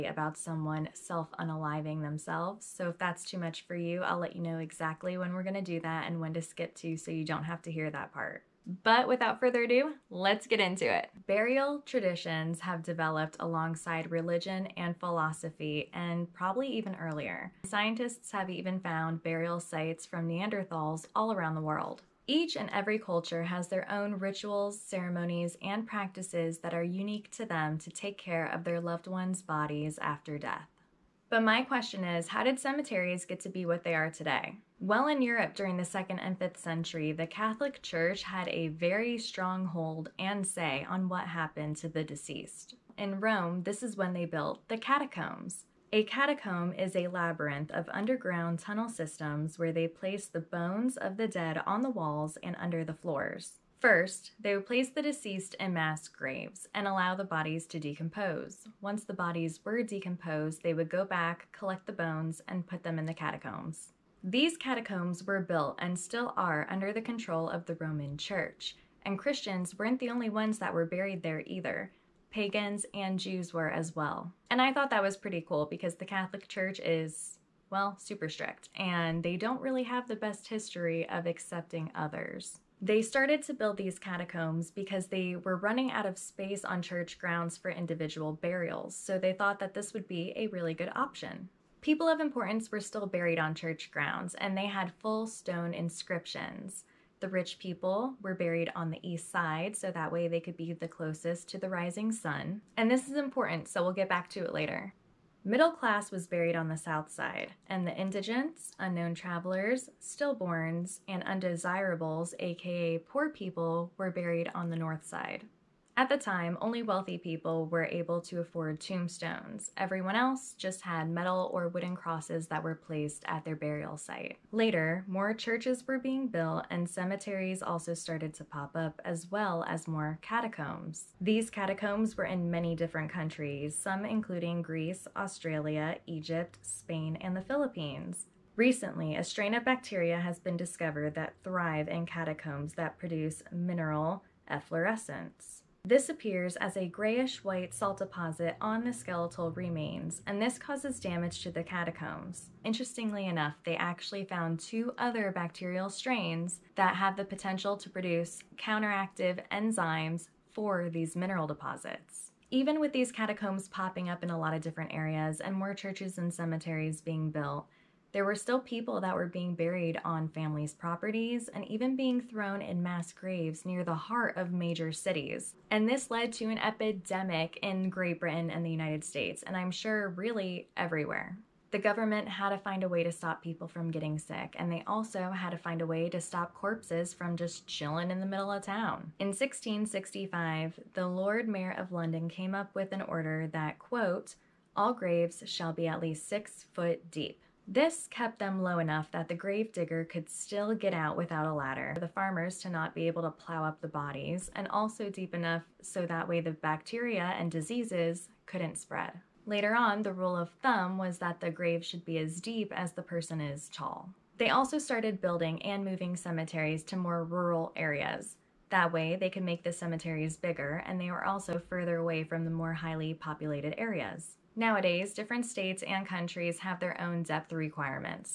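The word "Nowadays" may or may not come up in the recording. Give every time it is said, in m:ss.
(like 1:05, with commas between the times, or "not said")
3:44.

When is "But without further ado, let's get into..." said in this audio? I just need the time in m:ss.
0:08.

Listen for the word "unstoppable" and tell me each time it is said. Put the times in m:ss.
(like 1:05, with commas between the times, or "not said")
not said.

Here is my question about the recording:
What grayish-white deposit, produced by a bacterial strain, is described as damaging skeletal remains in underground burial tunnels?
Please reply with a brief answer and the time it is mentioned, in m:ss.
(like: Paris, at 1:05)
Mineral efflorescence, at 2:23.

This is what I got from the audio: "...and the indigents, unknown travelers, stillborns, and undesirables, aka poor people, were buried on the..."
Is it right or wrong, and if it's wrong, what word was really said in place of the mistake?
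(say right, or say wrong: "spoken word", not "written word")
right.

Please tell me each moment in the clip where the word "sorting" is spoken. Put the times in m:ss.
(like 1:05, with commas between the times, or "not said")
not said.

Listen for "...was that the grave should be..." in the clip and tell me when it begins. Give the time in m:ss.
3:30.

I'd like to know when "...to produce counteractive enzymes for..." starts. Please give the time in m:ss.
2:37.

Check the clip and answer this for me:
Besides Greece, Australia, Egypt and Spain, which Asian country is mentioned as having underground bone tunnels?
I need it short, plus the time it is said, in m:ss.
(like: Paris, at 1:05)
The Philippines, at 2:17.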